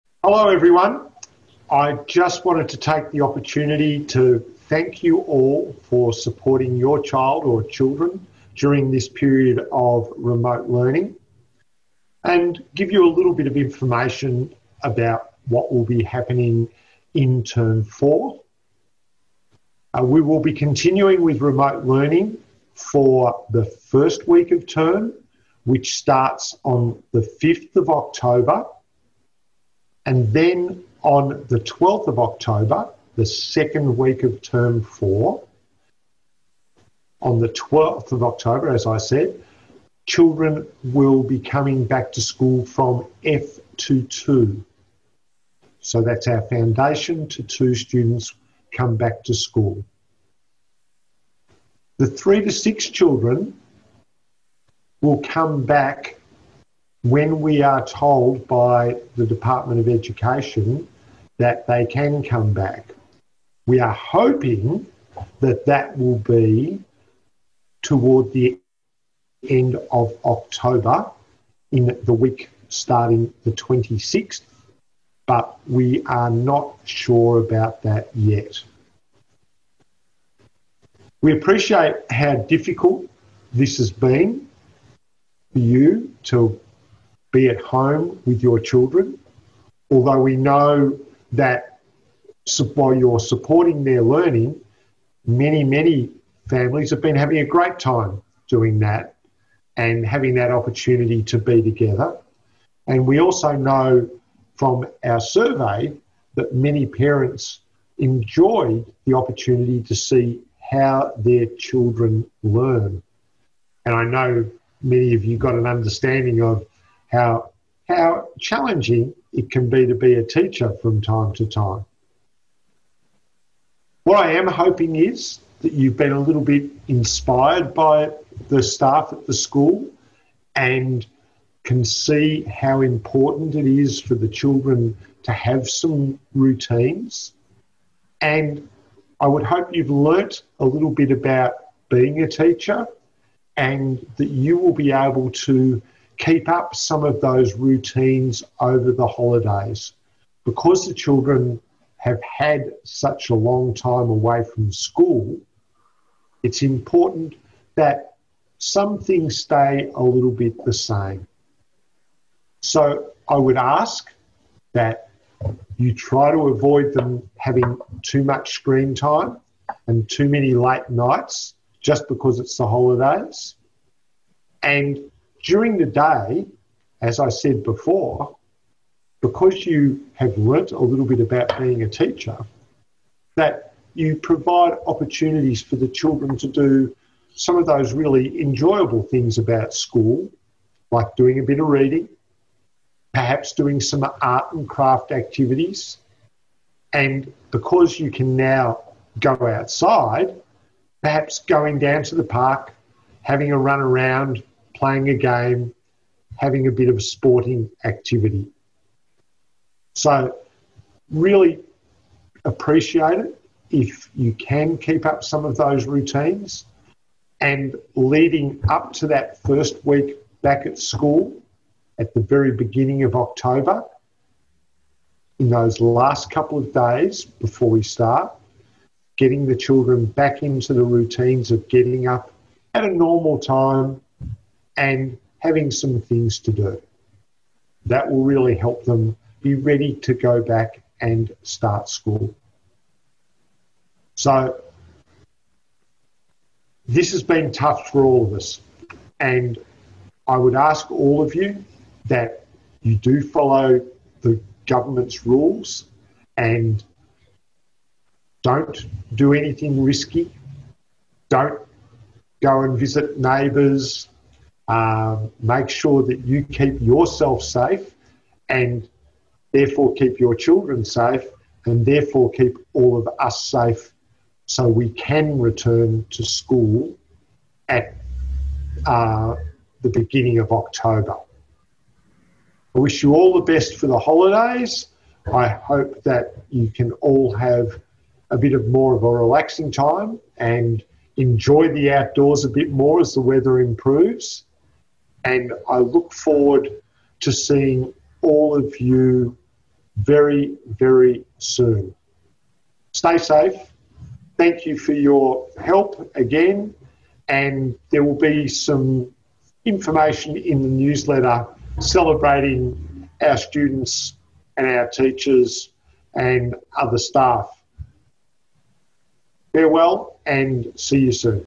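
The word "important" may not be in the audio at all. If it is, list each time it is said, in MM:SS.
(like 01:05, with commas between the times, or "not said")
02:12, 02:36.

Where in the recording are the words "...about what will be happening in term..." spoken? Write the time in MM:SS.
00:14.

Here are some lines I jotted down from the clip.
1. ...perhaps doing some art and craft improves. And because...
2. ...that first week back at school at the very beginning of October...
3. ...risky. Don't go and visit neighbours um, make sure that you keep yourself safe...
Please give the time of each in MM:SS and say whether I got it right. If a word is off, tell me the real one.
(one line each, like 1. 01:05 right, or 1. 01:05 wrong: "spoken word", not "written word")
1. 03:13 wrong: "activities", not "improves"
2. 03:39 right
3. 04:19 right.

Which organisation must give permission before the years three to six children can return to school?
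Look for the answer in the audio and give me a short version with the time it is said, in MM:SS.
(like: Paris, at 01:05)
Department of Education, at 00:59.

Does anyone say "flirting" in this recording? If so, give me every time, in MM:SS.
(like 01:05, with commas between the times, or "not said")
not said.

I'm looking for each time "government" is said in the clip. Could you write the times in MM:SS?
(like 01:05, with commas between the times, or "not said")
04:14.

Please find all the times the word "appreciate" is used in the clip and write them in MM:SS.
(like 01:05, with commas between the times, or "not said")
01:21, 03:32.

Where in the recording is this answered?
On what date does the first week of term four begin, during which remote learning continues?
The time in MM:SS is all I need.
00:27.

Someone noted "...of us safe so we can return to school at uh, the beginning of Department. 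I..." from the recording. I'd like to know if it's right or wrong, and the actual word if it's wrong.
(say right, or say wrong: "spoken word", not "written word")
wrong: "October", not "Department".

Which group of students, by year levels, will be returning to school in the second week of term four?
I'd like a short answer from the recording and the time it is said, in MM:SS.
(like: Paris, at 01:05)
F to 2, at 00:43.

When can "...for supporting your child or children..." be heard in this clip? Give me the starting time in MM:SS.
00:05.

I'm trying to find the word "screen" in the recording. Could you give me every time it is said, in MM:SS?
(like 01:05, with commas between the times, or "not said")
02:48.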